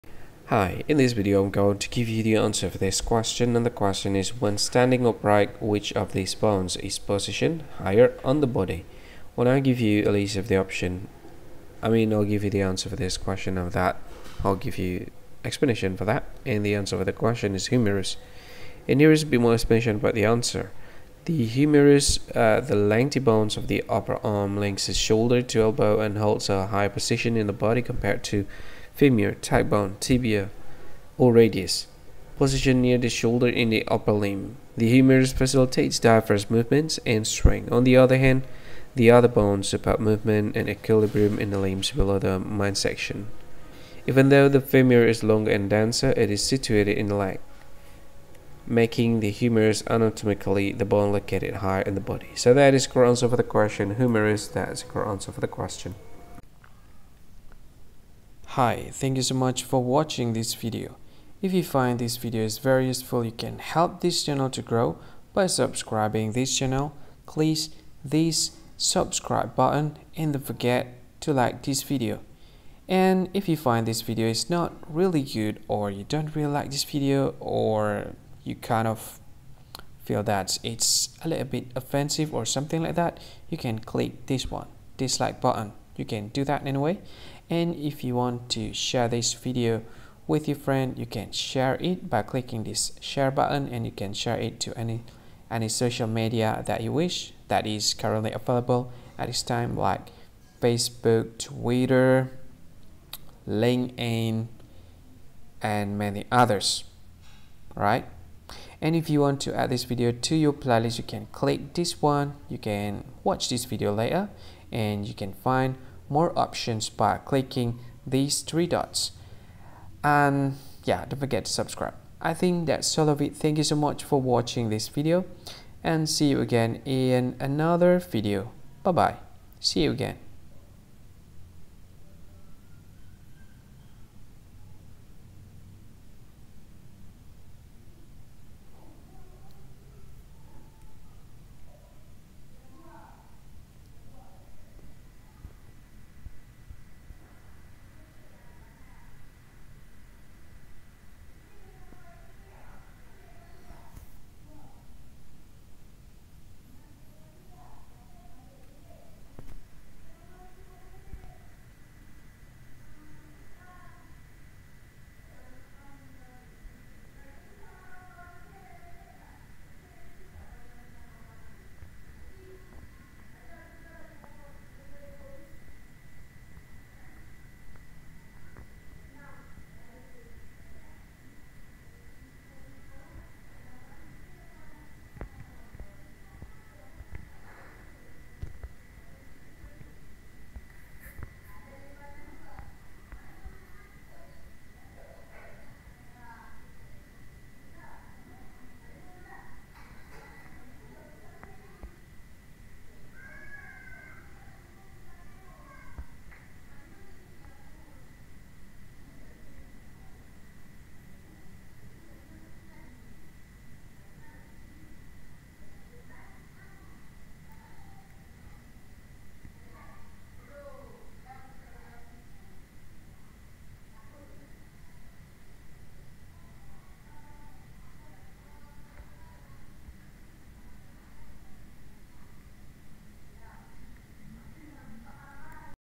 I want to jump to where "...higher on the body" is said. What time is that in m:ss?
0:07.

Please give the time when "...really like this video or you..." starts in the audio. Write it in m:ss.
1:16.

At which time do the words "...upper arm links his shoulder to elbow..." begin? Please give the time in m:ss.
0:23.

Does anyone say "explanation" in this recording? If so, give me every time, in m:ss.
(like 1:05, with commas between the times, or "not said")
0:15, 0:19.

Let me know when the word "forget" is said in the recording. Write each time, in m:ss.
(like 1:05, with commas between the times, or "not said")
1:10, 2:01.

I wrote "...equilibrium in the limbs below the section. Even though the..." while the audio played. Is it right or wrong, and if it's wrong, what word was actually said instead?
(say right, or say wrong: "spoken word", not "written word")
right.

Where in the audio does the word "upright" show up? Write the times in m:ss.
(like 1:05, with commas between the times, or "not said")
0:05.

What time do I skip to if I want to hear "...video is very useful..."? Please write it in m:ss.
1:02.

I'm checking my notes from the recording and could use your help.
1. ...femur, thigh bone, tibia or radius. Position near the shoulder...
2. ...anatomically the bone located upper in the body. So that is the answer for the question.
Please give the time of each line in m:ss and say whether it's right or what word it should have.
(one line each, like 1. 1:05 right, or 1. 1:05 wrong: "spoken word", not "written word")
1. 0:28 right
2. 0:49 wrong: "higher", not "upper".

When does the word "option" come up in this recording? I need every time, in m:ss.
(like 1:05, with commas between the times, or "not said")
0:10, 1:56.